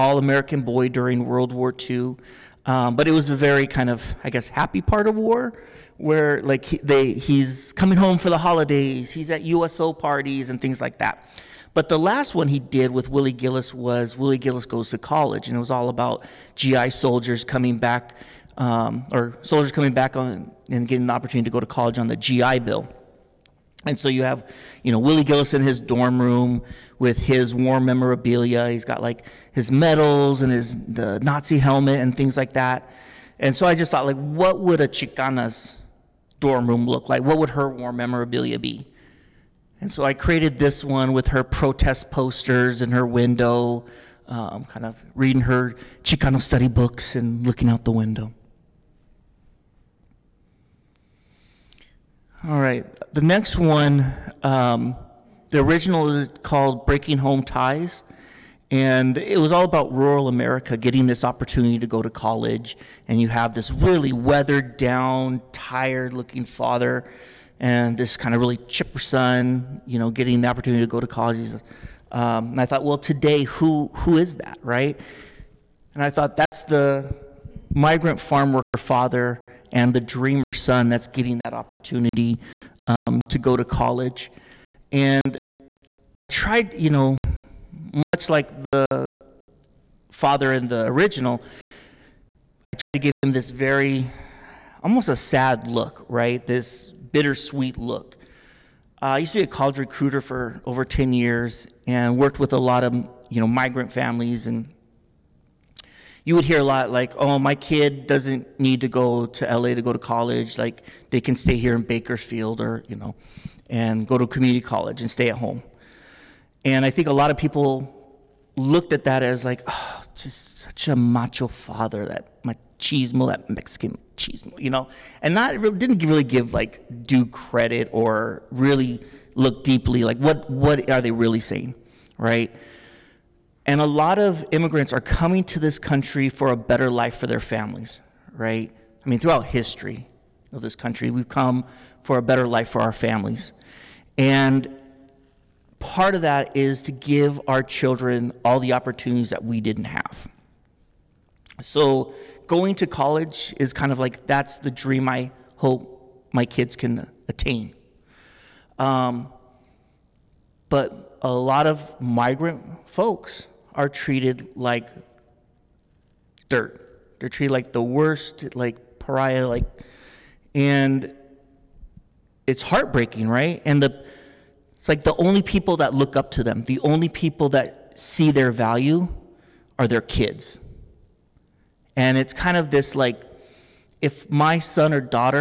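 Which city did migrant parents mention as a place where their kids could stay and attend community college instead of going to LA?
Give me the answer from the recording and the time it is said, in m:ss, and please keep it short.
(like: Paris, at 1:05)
Bakersfield, at 1:51.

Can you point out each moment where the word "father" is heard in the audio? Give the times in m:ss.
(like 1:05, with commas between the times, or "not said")
1:06, 1:18, 1:30, 2:01.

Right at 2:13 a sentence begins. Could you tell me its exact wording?
And a lot of immigrants are coming to this country for a better life for their families, right?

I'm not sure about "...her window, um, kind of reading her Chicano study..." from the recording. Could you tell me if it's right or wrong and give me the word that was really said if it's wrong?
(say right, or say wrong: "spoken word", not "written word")
right.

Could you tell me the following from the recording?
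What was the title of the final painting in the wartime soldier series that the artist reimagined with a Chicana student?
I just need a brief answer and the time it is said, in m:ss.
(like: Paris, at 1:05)
Willie Gillis Goes to College, at 0:14.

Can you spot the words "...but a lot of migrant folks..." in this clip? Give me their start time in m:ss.
2:40.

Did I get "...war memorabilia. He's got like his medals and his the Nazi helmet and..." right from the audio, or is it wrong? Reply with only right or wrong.
right.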